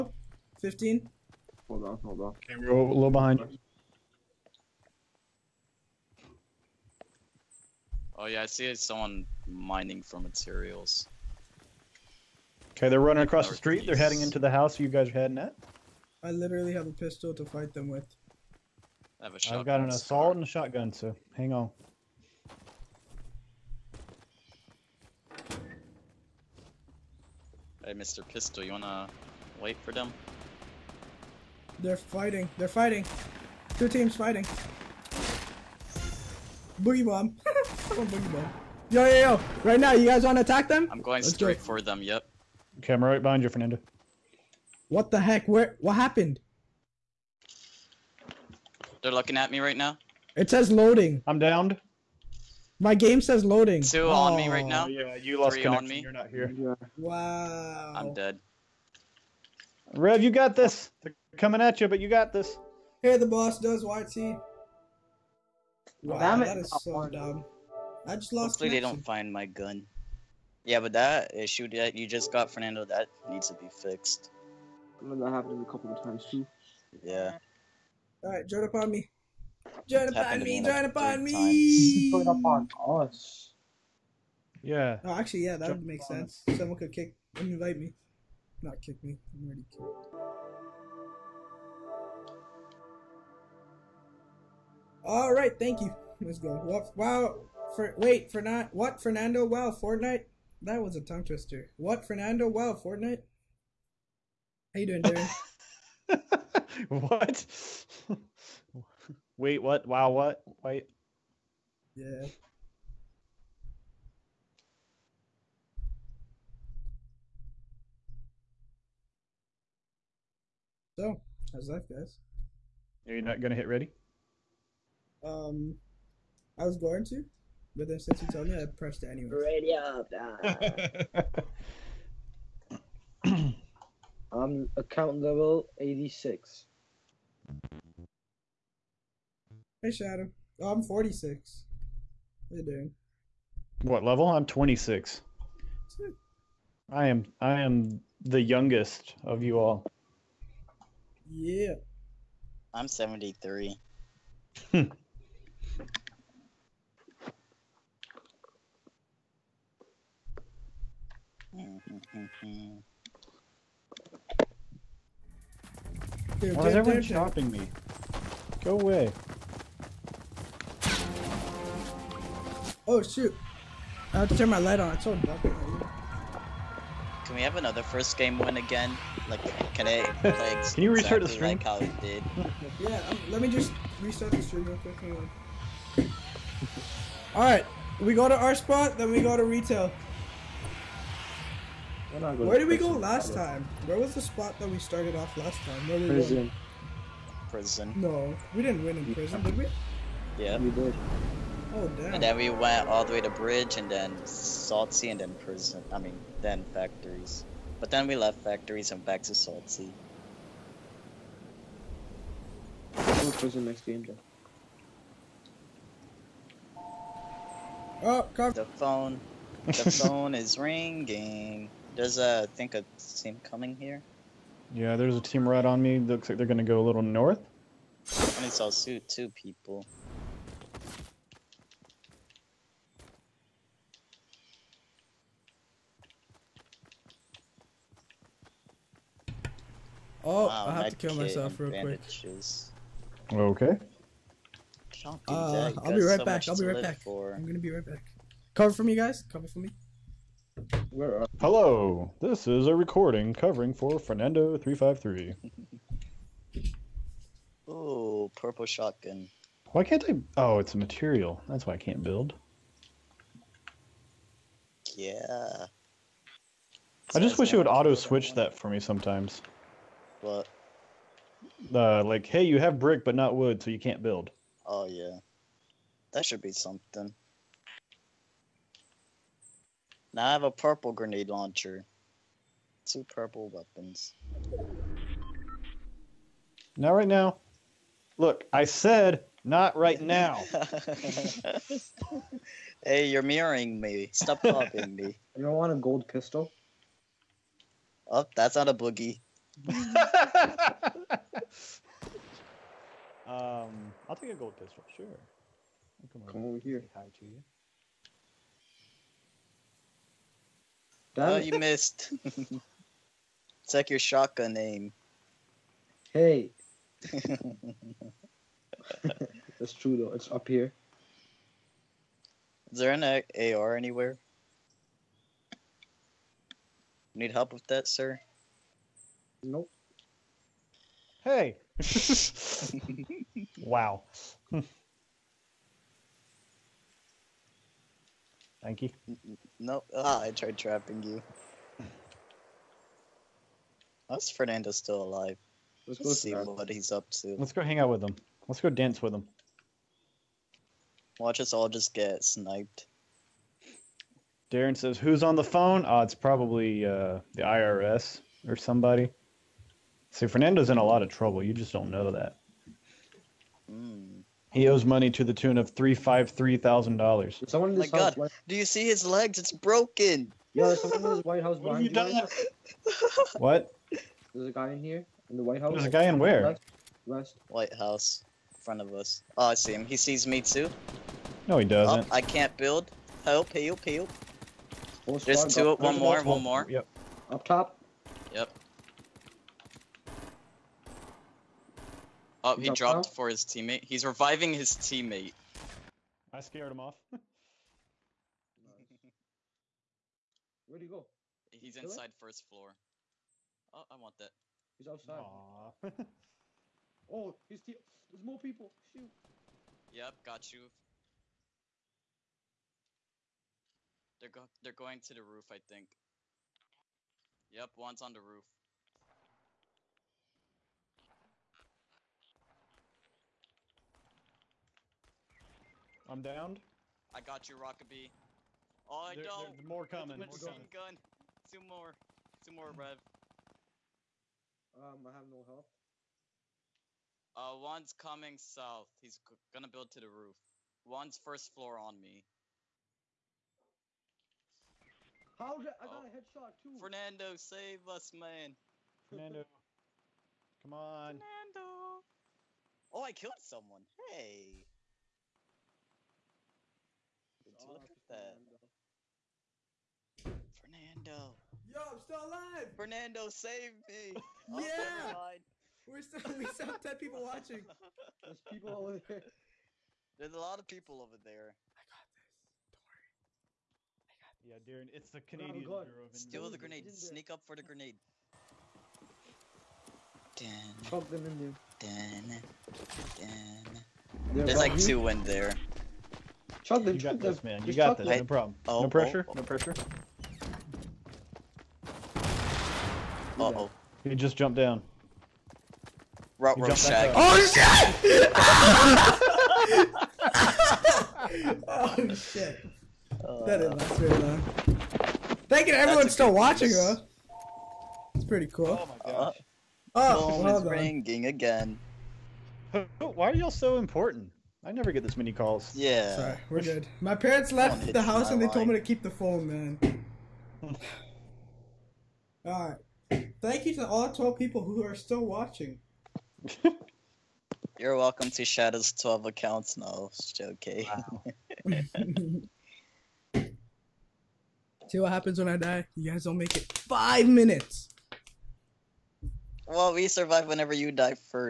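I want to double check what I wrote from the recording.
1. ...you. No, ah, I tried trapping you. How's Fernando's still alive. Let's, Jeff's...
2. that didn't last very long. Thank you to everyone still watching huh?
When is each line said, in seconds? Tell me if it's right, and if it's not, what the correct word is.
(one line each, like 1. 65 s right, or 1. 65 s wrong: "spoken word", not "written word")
1. 338 s wrong: "Let", not "Jeff"
2. 503 s right.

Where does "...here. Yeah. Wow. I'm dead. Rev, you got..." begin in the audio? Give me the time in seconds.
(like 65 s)
56 s.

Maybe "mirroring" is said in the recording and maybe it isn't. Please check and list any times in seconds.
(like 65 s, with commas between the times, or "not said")
293 s.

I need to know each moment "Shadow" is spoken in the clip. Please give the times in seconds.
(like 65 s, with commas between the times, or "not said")
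139 s, 528 s.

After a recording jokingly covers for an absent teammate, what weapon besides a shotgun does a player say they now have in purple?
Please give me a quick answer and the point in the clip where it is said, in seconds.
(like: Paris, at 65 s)
Grenade launcher, at 280 s.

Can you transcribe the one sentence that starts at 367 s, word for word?
Someone in oh this My house.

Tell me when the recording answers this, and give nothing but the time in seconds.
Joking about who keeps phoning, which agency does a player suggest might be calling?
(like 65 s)
357 s.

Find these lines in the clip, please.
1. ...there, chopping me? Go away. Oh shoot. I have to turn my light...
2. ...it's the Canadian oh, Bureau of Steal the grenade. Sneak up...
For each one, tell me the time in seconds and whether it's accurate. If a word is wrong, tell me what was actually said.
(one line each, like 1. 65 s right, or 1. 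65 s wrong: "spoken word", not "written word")
1. 166 s right
2. 474 s right.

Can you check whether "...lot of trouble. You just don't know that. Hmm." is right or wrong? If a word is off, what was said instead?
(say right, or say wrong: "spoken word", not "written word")
right.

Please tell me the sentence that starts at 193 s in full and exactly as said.
Where was the spot that we started off last time?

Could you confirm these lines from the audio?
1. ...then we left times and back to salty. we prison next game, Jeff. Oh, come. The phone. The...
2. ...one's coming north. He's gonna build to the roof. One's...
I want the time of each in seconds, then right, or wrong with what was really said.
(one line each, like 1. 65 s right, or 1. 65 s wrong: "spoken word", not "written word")
1. 207 s wrong: "factories", not "times"
2. 437 s wrong: "south", not "north".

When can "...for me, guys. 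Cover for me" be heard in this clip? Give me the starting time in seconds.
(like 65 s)
248 s.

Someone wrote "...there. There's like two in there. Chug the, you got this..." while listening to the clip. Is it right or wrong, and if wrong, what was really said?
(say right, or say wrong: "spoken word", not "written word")
right.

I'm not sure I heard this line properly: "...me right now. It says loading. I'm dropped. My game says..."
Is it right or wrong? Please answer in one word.
wrong.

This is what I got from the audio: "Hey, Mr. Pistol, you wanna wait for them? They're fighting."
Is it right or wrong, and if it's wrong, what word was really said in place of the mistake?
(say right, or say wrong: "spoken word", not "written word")
right.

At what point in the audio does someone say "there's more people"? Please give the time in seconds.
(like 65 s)
408 s.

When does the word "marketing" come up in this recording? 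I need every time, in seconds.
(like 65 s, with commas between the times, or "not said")
not said.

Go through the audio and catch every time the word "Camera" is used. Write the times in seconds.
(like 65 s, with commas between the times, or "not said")
42 s.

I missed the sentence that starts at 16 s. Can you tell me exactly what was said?
I literally have a pistol to fight them with.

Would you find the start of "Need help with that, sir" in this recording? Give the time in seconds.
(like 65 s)
327 s.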